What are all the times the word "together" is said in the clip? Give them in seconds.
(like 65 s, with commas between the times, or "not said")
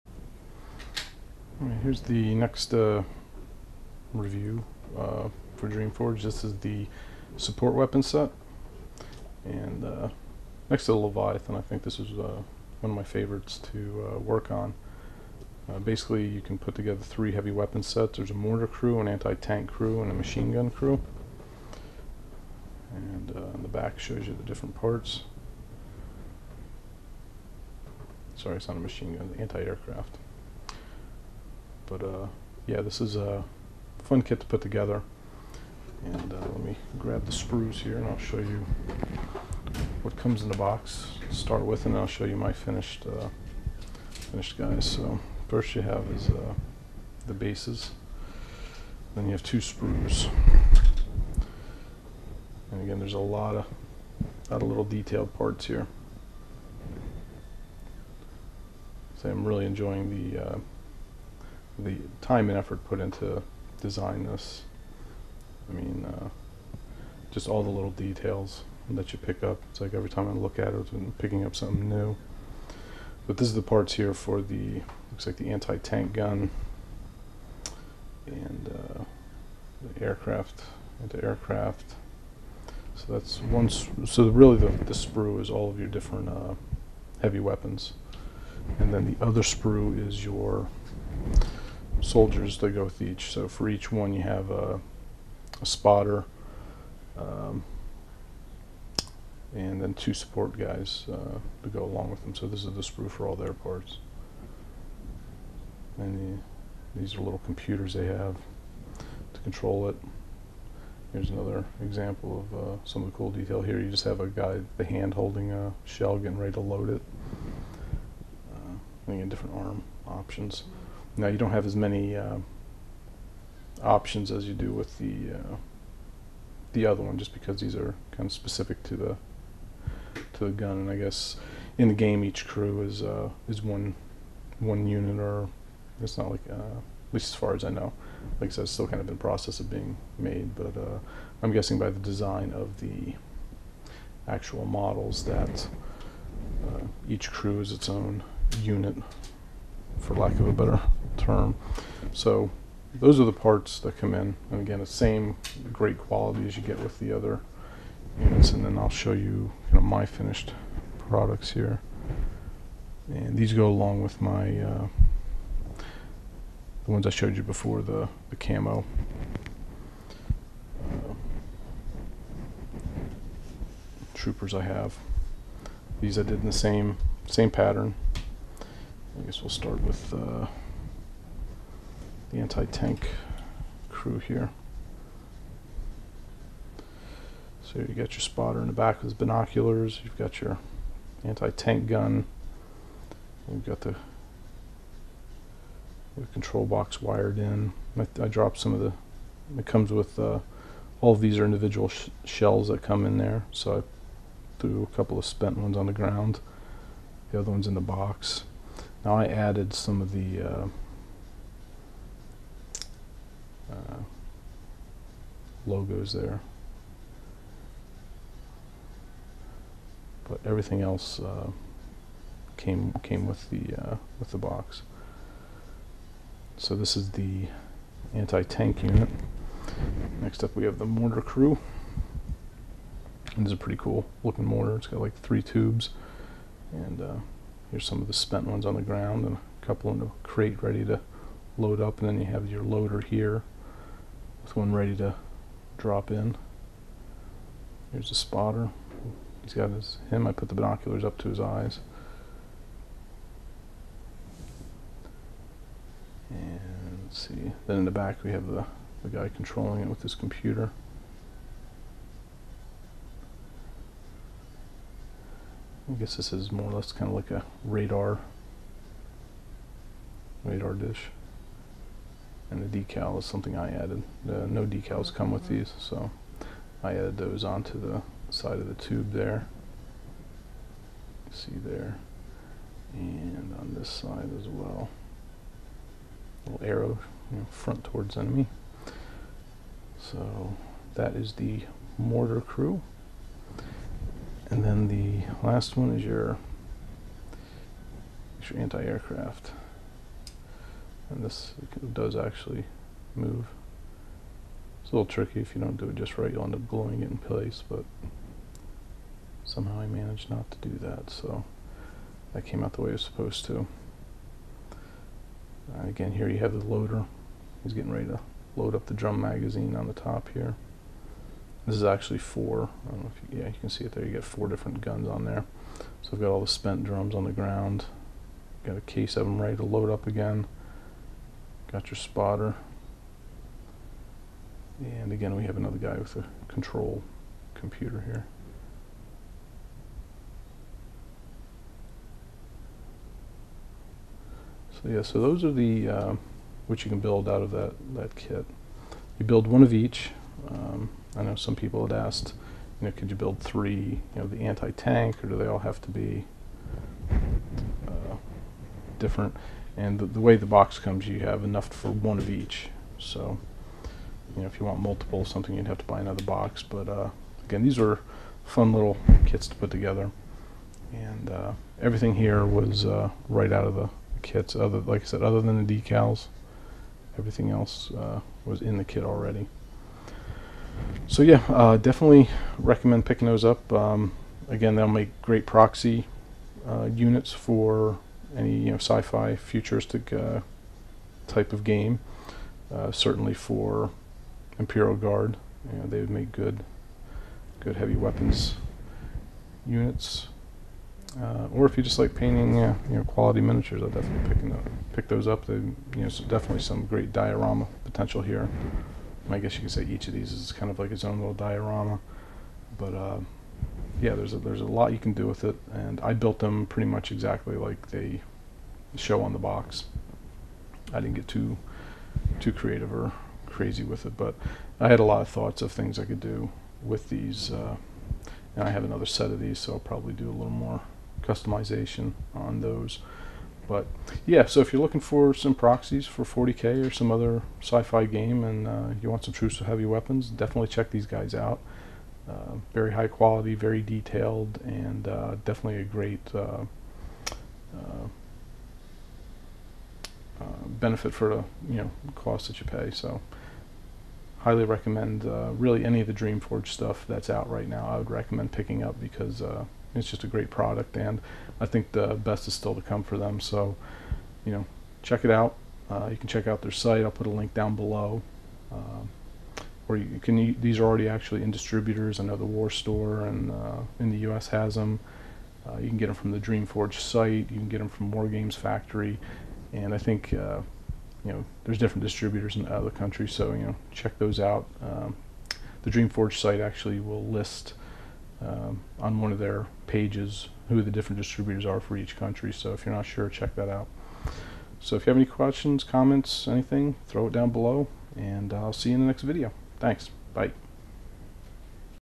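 16 s, 34 s, 369 s.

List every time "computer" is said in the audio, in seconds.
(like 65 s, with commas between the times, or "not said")
107 s, 260 s, 337 s.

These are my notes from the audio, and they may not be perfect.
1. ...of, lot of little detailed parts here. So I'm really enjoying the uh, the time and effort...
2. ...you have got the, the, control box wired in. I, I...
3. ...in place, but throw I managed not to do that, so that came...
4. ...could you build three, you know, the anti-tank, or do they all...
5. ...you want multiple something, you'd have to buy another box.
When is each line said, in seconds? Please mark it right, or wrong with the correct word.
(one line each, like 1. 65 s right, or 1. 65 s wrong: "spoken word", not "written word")
1. 53 s right
2. 193 s right
3. 307 s wrong: "somehow", not "throw"
4. 352 s right
5. 364 s right.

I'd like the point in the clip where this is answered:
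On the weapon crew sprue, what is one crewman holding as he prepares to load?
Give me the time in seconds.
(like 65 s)
115 s.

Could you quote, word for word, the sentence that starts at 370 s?
And uh, everything here was uh, right out of the kits.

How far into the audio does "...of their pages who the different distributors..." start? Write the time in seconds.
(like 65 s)
489 s.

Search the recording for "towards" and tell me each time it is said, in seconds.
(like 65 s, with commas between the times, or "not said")
287 s.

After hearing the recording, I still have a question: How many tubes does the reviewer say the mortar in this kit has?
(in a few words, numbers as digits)
3.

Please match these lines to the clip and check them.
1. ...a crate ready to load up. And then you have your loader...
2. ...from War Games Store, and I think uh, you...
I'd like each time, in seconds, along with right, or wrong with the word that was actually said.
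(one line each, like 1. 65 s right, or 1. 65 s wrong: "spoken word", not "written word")
1. 240 s right
2. 477 s wrong: "Factory", not "Store".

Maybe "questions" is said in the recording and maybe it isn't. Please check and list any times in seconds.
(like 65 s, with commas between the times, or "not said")
495 s.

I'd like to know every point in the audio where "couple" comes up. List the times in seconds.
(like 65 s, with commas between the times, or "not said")
204 s, 239 s.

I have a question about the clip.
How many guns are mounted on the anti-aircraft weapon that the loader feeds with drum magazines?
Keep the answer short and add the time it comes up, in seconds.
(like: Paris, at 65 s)
4, at 324 s.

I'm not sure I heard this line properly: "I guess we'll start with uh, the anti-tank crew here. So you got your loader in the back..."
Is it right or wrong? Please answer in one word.
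wrong.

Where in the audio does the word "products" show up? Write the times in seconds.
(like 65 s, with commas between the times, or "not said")
161 s, 460 s.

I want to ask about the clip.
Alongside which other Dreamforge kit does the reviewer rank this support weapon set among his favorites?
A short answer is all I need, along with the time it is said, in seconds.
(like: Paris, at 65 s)
Leviathan, at 10 s.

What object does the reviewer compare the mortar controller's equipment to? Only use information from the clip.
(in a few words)
Radar dish.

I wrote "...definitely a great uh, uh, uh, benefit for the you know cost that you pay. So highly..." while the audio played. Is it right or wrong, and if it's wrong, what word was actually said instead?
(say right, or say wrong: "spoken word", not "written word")
right.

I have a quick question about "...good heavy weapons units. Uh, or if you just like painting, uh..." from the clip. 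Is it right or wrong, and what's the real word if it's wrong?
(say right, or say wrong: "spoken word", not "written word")
right.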